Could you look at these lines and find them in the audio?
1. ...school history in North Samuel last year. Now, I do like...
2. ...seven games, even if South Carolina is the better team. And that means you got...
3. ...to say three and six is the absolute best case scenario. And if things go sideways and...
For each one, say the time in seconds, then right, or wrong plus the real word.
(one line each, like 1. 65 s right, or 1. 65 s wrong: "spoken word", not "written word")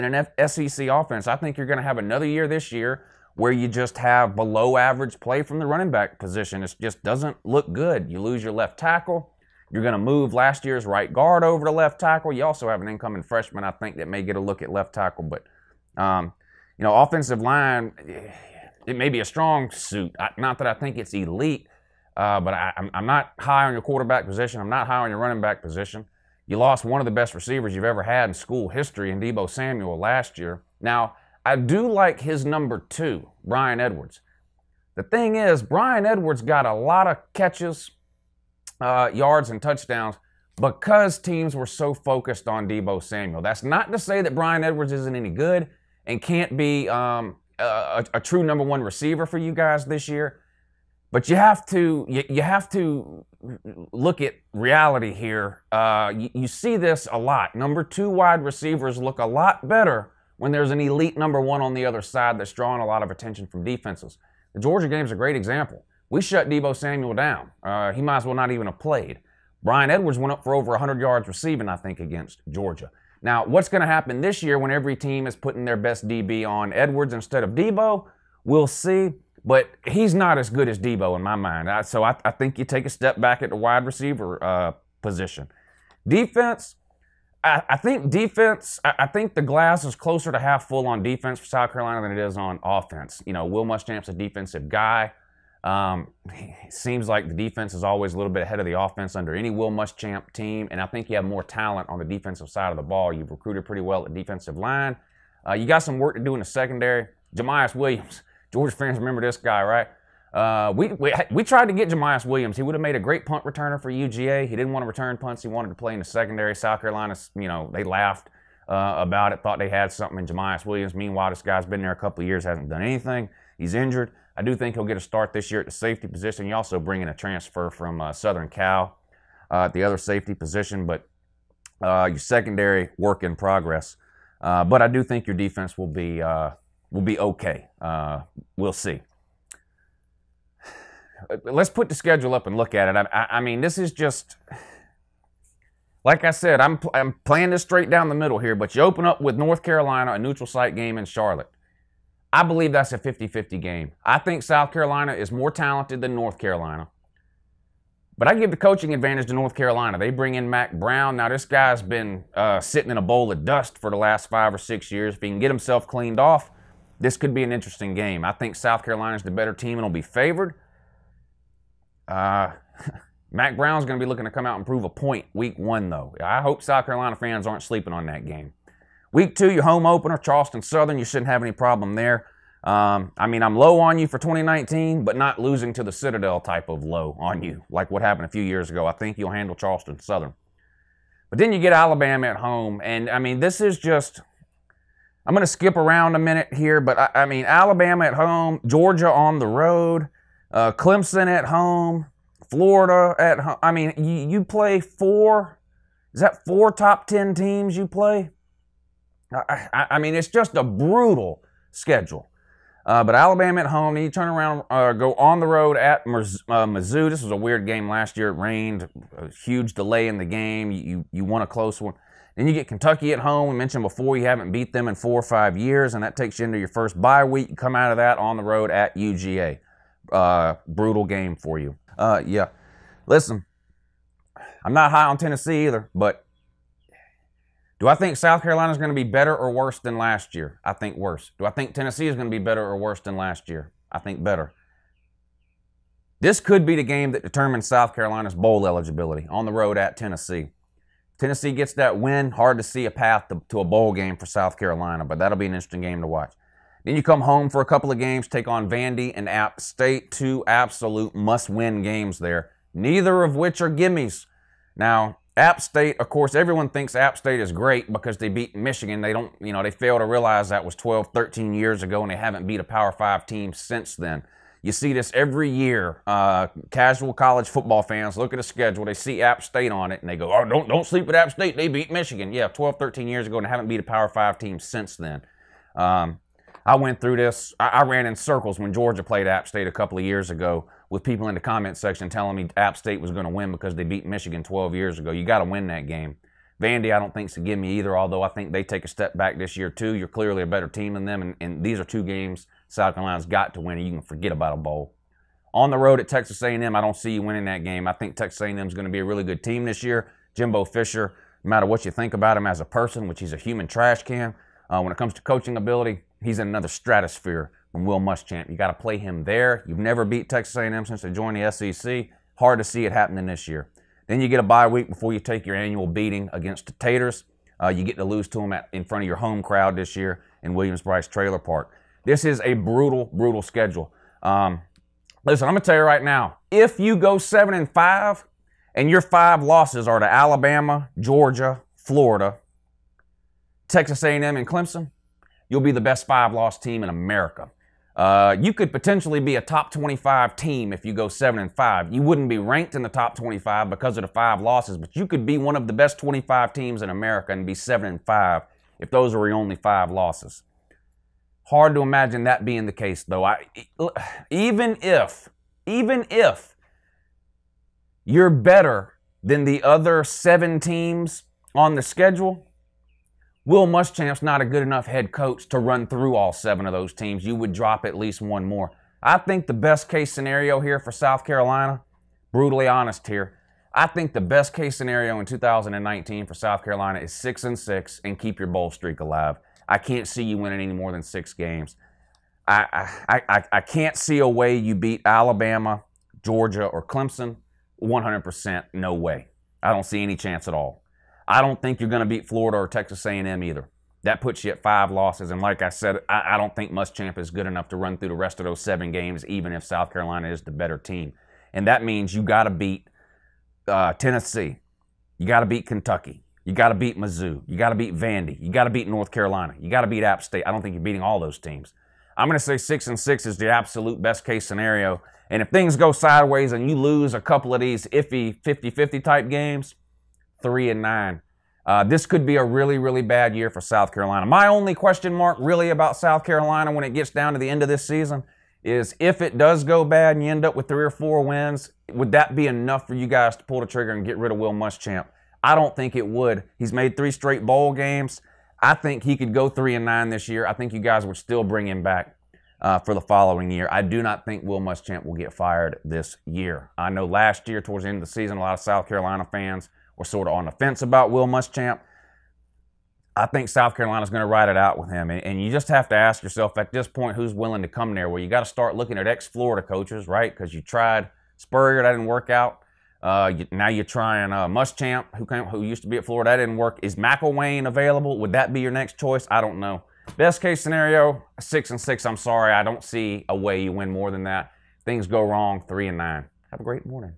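1. 28 s wrong: "Deebo", not "North"
2. 408 s right
3. 422 s wrong: "six", not "three".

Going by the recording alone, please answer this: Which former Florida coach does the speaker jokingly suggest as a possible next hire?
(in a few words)
McElwain.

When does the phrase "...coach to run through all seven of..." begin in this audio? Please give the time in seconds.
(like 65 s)
375 s.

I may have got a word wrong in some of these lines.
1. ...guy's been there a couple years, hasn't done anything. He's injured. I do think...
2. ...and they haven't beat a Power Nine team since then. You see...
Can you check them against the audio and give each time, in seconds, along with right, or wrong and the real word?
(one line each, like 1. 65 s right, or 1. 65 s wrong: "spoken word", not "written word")
1. 121 s right
2. 272 s wrong: "Five", not "Nine".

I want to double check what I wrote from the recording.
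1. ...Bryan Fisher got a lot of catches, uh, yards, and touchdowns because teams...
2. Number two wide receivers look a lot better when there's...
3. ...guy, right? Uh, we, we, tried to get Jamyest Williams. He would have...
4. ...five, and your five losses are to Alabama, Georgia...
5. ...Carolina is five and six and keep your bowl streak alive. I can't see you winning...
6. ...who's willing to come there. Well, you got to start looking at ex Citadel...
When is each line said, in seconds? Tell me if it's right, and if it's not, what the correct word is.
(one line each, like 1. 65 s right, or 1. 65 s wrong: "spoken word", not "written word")
1. 35 s wrong: "Edwards", not "Fisher"
2. 57 s right
3. 109 s right
4. 337 s right
5. 386 s wrong: "six", not "five"
6. 467 s wrong: "Florida", not "Citadel".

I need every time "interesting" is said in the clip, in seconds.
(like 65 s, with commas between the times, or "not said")
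167 s, 255 s.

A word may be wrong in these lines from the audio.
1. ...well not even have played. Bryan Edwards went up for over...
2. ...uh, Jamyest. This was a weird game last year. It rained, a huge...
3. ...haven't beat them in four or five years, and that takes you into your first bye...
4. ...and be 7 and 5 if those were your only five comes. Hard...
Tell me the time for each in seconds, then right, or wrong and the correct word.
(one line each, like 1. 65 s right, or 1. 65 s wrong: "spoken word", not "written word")
1. 68 s right
2. 216 s wrong: "Mizzou", not "Jamyest"
3. 224 s right
4. 357 s wrong: "losses", not "comes".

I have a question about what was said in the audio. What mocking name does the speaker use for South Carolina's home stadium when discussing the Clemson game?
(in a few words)
Williams-Brice Trailer Park.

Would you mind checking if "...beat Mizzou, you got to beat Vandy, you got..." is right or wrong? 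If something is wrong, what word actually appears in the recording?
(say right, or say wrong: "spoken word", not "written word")
right.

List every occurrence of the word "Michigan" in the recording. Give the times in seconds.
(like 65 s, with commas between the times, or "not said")
268 s, 281 s, 294 s.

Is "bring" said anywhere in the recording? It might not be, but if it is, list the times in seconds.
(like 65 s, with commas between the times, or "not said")
126 s, 160 s, 451 s.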